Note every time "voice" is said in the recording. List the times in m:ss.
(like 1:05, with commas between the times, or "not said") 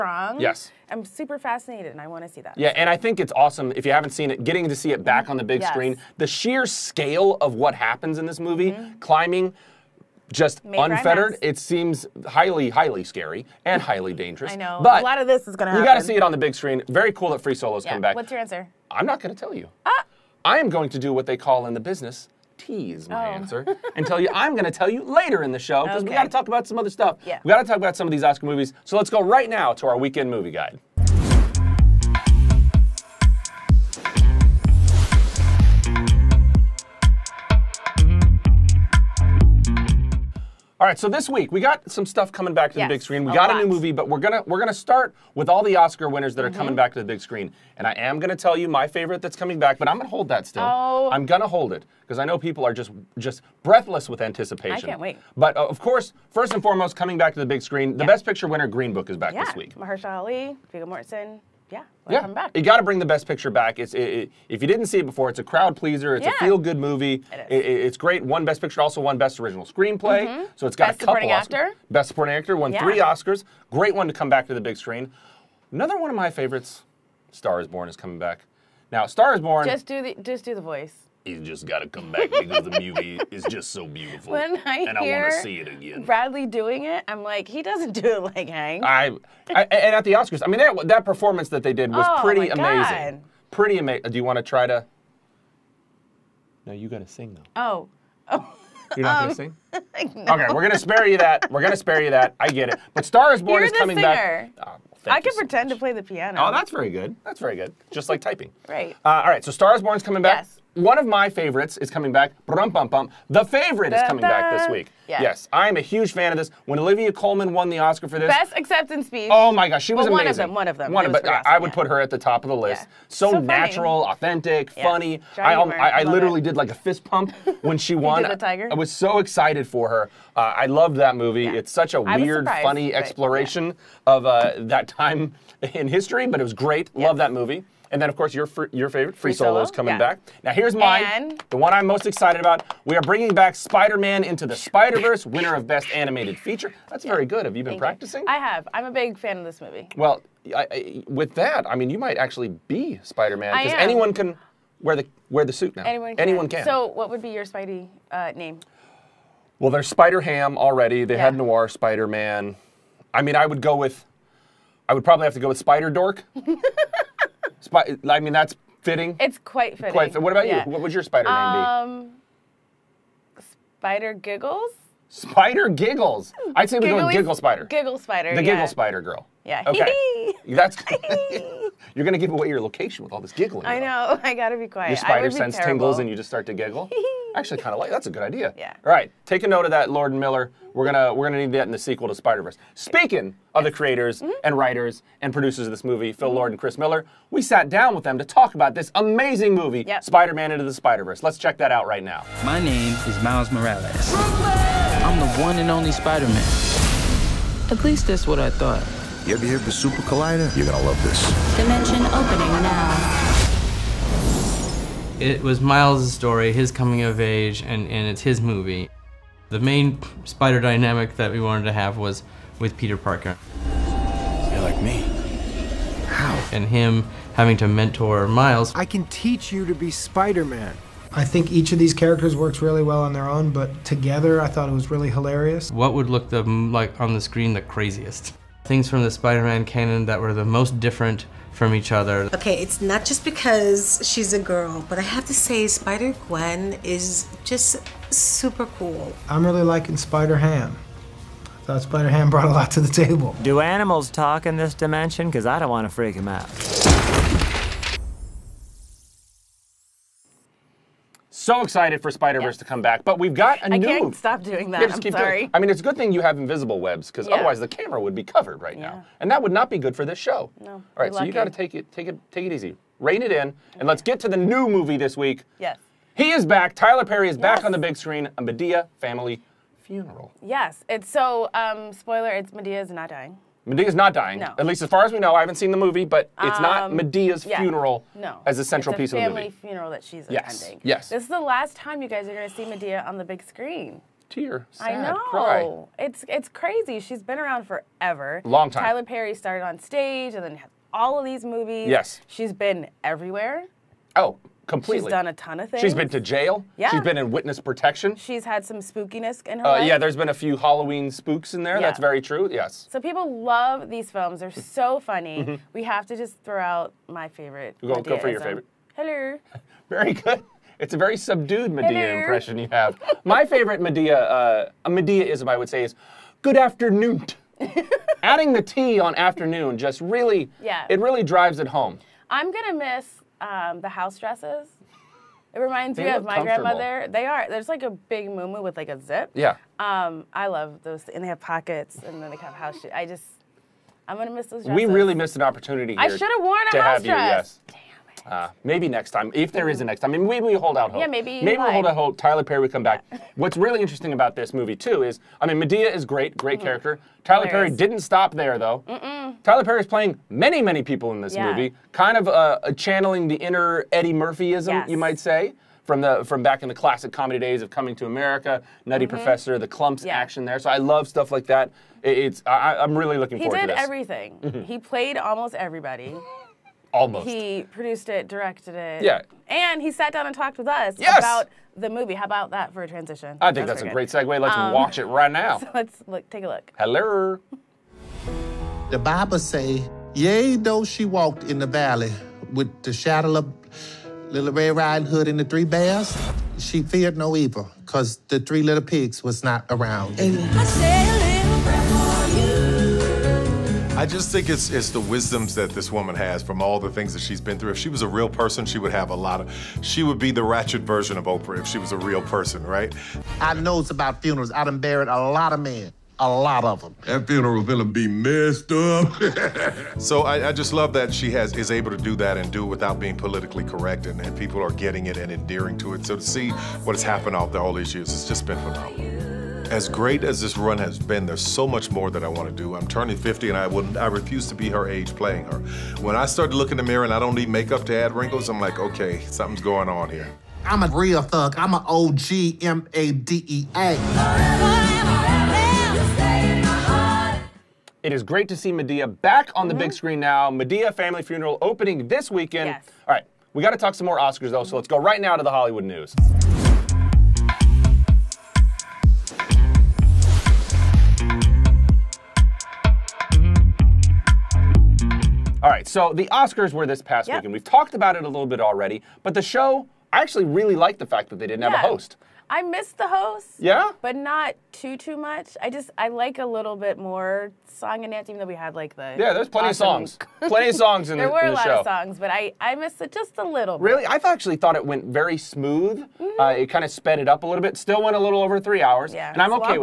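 1:20.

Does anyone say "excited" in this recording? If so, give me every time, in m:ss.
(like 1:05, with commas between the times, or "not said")
2:09, 2:22, 4:21.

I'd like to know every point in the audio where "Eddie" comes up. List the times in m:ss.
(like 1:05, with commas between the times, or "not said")
6:03.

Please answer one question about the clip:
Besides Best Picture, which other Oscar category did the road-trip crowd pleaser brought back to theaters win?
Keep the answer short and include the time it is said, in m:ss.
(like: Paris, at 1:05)
Best original screenplay, at 1:09.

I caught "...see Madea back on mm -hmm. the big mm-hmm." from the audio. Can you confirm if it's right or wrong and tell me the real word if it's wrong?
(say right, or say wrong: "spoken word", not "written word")
right.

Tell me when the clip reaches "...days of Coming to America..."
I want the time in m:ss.
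6:07.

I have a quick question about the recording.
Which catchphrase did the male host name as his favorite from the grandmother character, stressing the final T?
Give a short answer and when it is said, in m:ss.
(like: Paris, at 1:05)
Good afternoon, at 5:26.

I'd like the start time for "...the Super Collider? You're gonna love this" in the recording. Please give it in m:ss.
3:29.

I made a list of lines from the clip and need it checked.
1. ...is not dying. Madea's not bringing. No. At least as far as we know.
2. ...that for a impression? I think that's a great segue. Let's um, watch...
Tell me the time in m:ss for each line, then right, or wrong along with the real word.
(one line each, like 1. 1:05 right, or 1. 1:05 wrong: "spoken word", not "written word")
1. 4:42 wrong: "dying", not "bringing"
2. 6:22 wrong: "transition", not "impression".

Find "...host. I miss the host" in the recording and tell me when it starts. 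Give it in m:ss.
7:51.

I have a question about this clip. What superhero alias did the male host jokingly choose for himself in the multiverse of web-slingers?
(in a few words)
Spider Dork.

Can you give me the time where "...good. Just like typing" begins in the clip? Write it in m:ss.
1:47.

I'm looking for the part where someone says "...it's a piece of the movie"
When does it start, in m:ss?
4:48.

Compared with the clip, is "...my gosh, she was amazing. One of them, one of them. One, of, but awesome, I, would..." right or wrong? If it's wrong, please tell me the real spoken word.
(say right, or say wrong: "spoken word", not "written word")
right.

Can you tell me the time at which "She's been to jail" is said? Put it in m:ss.
5:05.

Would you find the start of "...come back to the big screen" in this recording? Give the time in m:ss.
1:14.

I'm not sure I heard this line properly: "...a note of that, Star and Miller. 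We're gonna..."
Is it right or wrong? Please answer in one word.
wrong.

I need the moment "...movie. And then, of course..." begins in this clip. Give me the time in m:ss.
2:17.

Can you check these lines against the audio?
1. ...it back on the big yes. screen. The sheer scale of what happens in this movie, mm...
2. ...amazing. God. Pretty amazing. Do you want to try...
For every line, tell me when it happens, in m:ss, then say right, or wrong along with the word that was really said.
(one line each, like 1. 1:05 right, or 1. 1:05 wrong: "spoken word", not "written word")
1. 0:04 right
2. 1:32 right.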